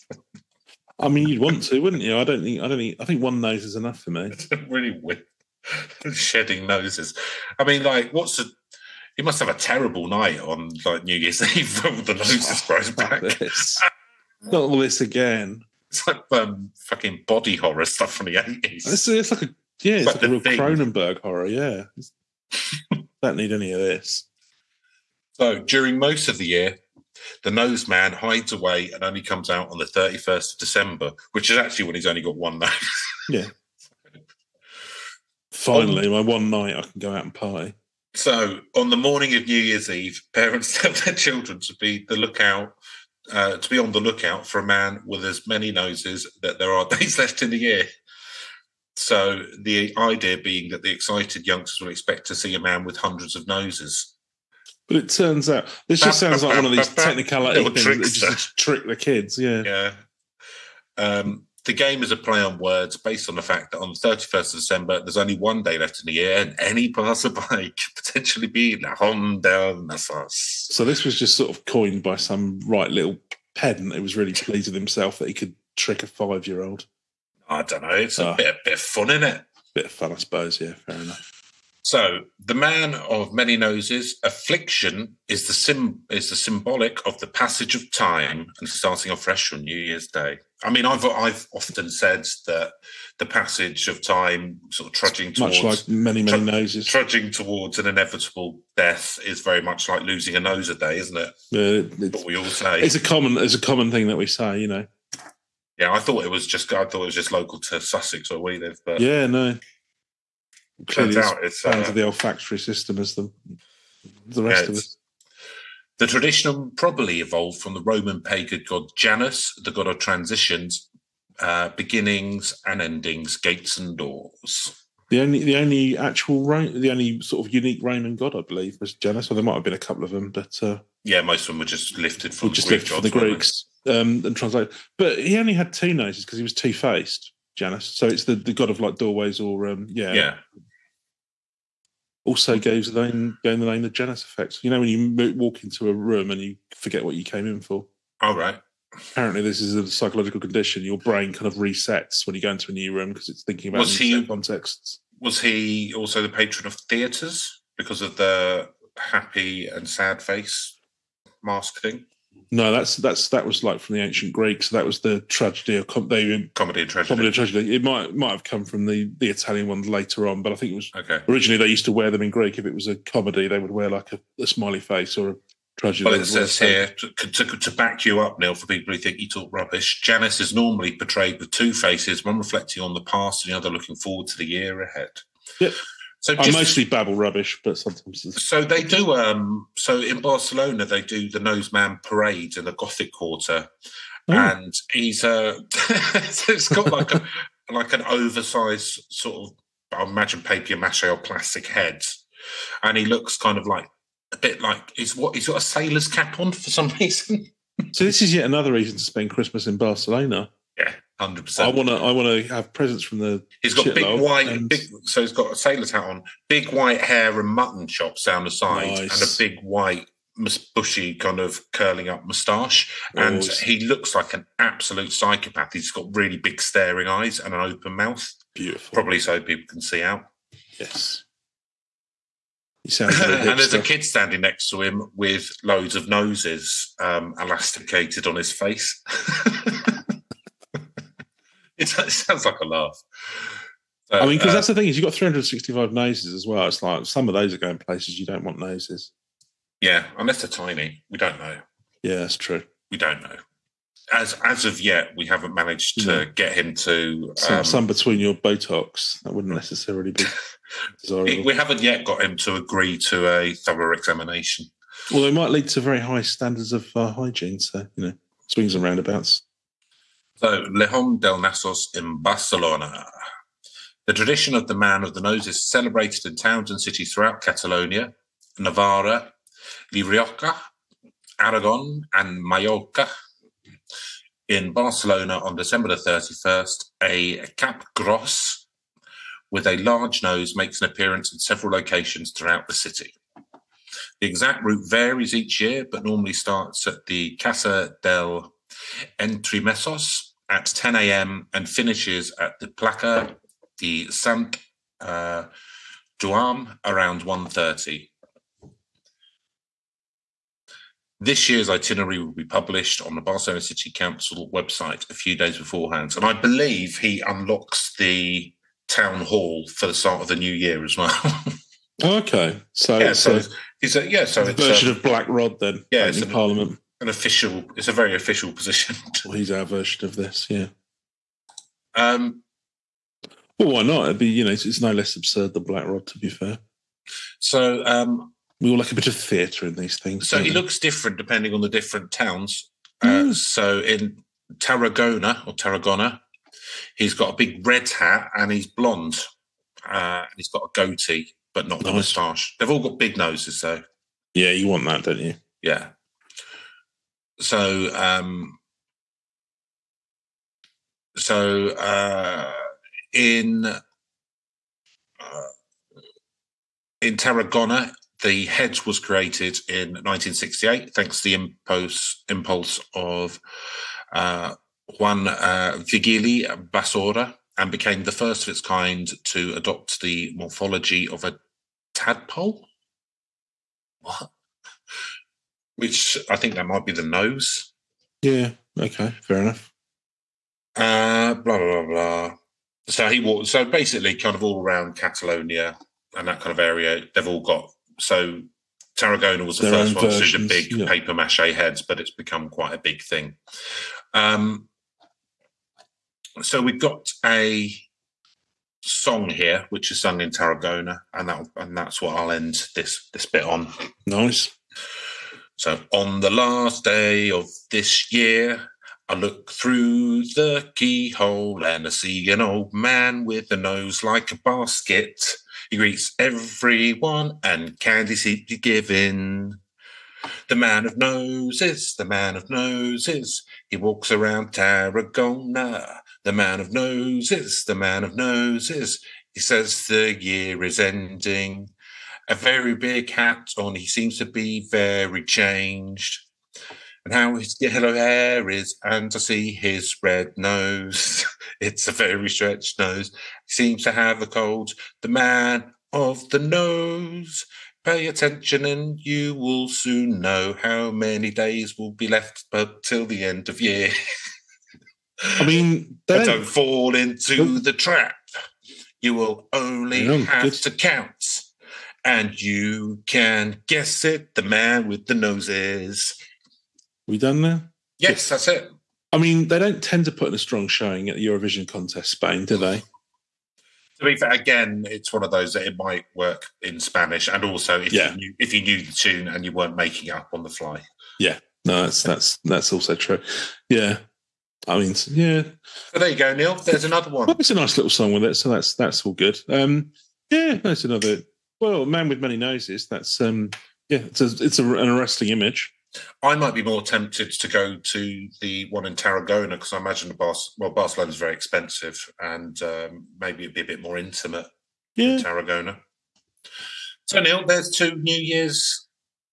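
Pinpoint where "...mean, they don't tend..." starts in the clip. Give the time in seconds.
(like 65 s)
479 s.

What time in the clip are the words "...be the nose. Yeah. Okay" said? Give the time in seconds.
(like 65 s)
386 s.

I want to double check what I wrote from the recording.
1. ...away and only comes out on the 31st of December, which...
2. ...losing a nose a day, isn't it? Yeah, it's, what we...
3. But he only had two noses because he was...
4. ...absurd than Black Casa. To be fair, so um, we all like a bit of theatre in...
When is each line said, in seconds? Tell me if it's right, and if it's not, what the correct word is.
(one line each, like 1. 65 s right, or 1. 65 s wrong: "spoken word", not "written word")
1. 28 s right
2. 100 s right
3. 134 s right
4. 335 s wrong: "Rod", not "Casa".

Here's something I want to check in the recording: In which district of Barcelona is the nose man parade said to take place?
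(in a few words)
Gothic Quarter.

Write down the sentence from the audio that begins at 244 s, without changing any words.
I mean, because uh, that's the uh, thing is you've got 365 noses as well.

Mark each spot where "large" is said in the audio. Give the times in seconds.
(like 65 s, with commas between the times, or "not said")
289 s.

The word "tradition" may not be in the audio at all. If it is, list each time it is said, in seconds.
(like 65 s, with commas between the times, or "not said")
116 s, 274 s.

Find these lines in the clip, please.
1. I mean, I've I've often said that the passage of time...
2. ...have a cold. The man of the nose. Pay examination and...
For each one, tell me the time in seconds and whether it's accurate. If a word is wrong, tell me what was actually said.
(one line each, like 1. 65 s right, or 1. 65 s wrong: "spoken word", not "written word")
1. 90 s right
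2. 453 s wrong: "attention", not "examination".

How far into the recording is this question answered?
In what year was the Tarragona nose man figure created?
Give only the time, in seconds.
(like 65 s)
370 s.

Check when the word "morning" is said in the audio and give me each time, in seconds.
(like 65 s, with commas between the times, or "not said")
38 s.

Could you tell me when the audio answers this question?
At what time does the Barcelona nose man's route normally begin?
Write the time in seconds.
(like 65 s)
300 s.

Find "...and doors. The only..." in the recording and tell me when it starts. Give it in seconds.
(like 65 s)
123 s.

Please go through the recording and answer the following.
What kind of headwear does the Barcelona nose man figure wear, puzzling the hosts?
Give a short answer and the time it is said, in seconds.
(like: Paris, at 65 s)
Sailor's cap, at 205 s.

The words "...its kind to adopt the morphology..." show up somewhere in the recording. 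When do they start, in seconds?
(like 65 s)
378 s.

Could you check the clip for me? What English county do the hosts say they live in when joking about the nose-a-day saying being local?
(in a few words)
Sussex.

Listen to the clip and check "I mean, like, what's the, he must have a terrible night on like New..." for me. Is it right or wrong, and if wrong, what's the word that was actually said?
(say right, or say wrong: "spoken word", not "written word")
right.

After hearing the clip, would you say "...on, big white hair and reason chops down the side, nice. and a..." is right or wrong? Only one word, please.
wrong.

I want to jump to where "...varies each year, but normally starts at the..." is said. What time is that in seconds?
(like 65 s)
294 s.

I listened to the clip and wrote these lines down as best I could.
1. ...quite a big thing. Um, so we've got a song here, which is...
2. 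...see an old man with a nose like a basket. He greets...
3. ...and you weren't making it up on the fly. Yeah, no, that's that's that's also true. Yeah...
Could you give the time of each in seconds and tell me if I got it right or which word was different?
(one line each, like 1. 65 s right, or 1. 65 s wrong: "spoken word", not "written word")
1. 402 s right
2. 421 s right
3. 489 s right.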